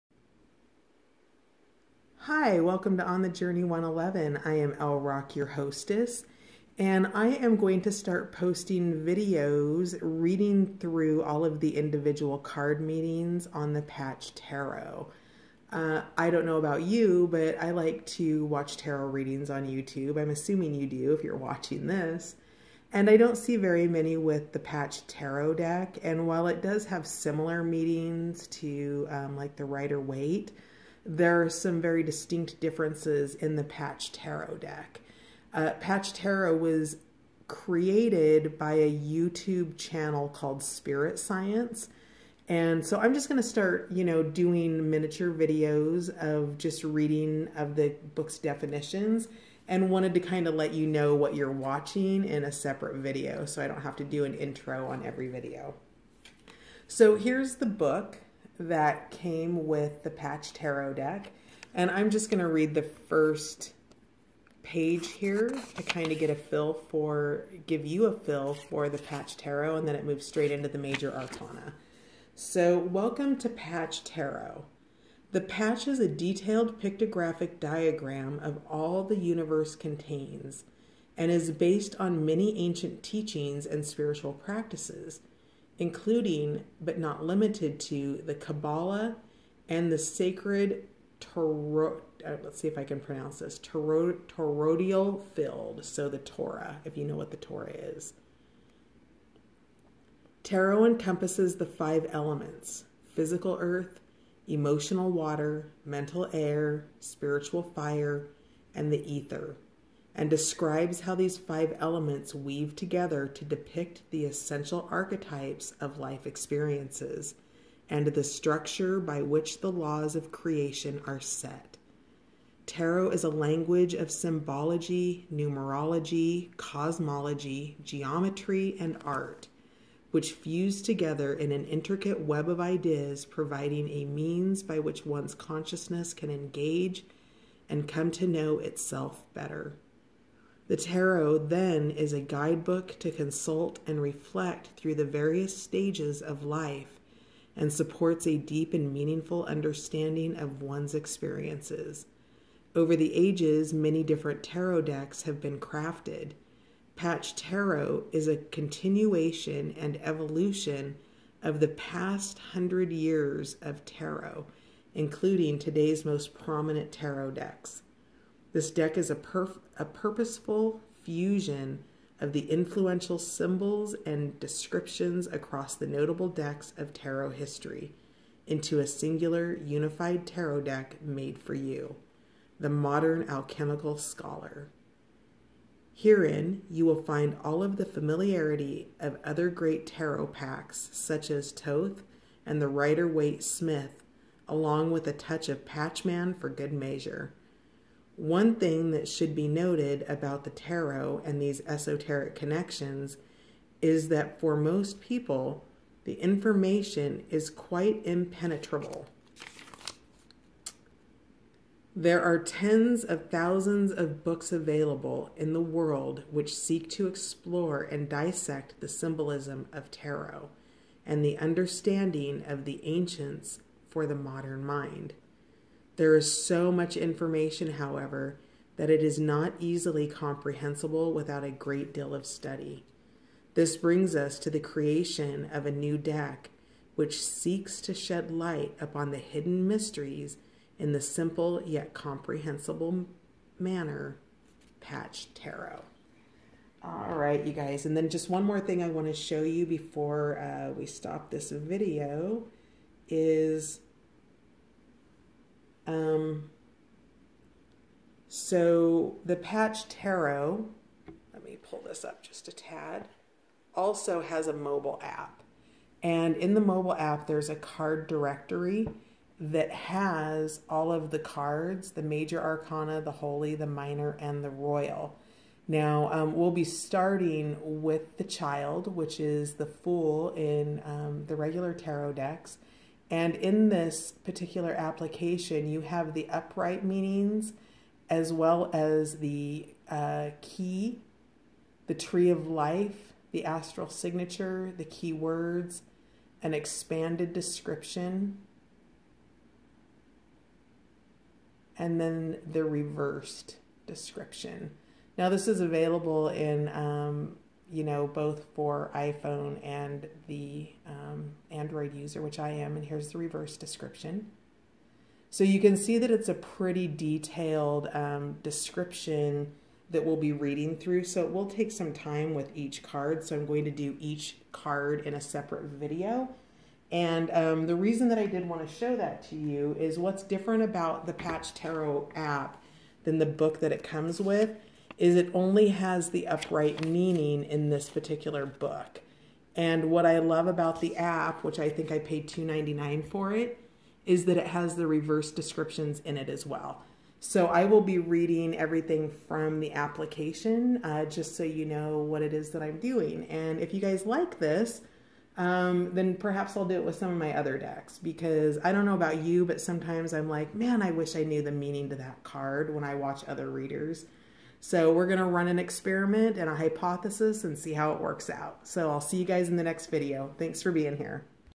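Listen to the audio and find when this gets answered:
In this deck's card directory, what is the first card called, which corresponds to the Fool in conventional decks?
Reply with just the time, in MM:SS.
04:38.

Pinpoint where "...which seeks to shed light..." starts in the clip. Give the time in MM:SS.
03:56.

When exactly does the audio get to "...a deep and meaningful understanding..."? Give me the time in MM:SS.
02:28.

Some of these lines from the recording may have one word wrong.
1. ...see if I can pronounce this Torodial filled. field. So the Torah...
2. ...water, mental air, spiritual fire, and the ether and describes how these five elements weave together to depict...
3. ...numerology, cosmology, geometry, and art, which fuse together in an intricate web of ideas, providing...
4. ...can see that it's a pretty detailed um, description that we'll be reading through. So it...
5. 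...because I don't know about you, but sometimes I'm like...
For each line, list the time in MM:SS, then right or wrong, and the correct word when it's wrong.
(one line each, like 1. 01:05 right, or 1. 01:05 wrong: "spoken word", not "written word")
1. 01:32 right
2. 01:45 right
3. 02:05 right
4. 05:15 right
5. 05:57 right.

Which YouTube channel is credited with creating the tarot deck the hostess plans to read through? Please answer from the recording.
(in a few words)
Spirit Science.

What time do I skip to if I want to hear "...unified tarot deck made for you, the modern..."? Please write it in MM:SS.
02:59.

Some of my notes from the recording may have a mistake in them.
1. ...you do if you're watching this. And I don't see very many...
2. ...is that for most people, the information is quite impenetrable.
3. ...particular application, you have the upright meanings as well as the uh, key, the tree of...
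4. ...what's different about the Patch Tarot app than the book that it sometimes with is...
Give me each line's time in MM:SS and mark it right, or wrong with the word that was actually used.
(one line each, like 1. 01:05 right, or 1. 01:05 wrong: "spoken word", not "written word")
1. 00:20 right
2. 03:23 right
3. 04:44 right
4. 05:29 wrong: "comes", not "sometimes".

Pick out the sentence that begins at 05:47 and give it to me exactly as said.
So I will be reading everything from the application uh, just so you know what it is that I'm doing.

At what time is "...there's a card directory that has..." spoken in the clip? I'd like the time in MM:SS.
04:27.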